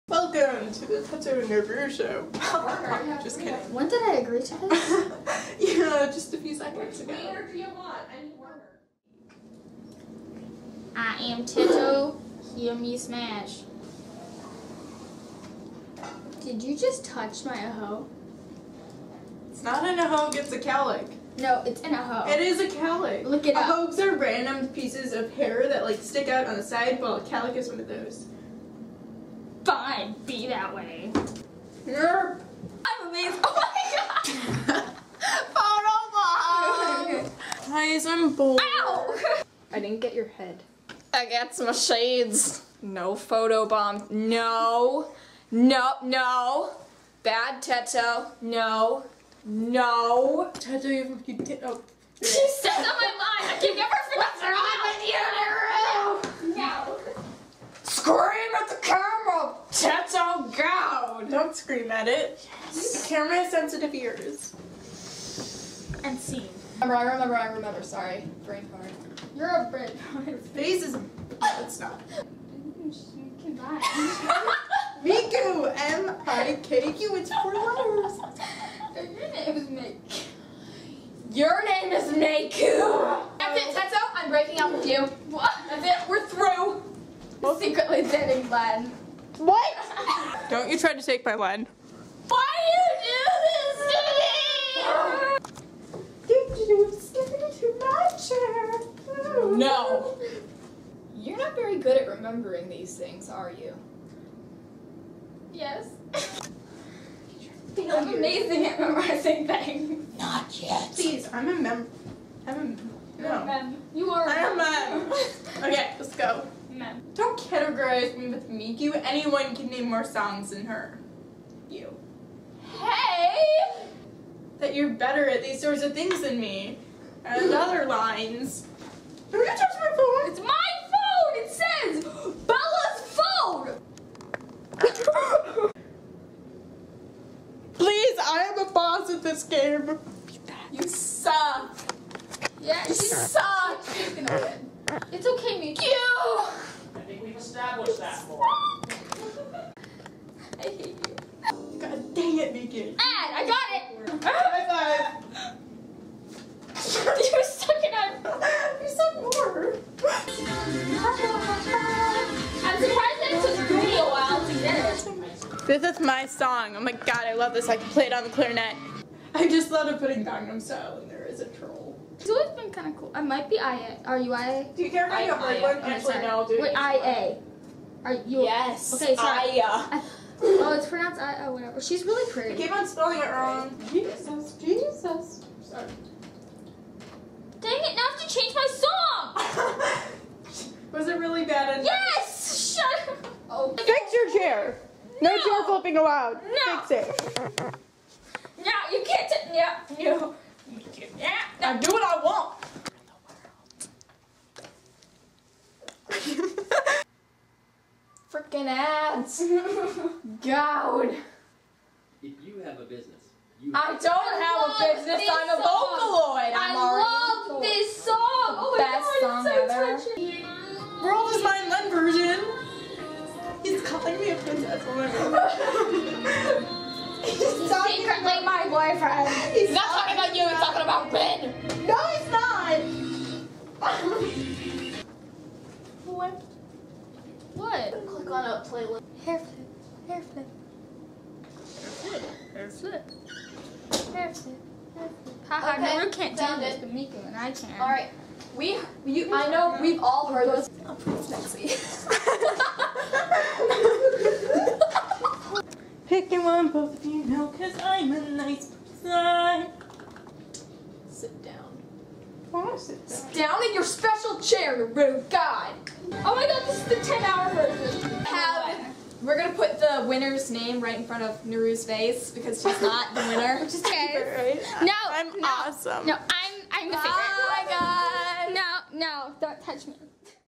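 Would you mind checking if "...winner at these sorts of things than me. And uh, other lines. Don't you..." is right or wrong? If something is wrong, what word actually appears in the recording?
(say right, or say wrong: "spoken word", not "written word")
wrong: "better", not "winner".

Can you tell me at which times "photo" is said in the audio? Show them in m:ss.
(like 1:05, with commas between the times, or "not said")
0:35, 0:43.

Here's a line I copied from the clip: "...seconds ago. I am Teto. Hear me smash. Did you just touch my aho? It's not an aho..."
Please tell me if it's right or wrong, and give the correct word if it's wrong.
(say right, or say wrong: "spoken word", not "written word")
right.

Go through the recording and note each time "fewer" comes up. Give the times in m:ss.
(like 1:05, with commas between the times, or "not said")
not said.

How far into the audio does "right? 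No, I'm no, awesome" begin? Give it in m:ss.
4:34.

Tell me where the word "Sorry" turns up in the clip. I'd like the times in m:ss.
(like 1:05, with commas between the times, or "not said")
1:07, 3:05.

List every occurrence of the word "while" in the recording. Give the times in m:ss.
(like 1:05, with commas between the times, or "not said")
0:26, 2:44.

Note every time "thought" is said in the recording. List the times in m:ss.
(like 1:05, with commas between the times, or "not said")
2:49.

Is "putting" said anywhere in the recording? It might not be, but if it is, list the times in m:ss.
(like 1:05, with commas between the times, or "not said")
2:49.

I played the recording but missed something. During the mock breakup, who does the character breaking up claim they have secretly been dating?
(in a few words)
Glenn.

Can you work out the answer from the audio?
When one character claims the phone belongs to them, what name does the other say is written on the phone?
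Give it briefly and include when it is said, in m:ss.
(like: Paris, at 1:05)
Bella, at 2:12.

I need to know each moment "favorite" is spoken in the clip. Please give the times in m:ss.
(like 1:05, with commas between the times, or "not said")
4:37.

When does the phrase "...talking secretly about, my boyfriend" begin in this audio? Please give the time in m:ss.
3:47.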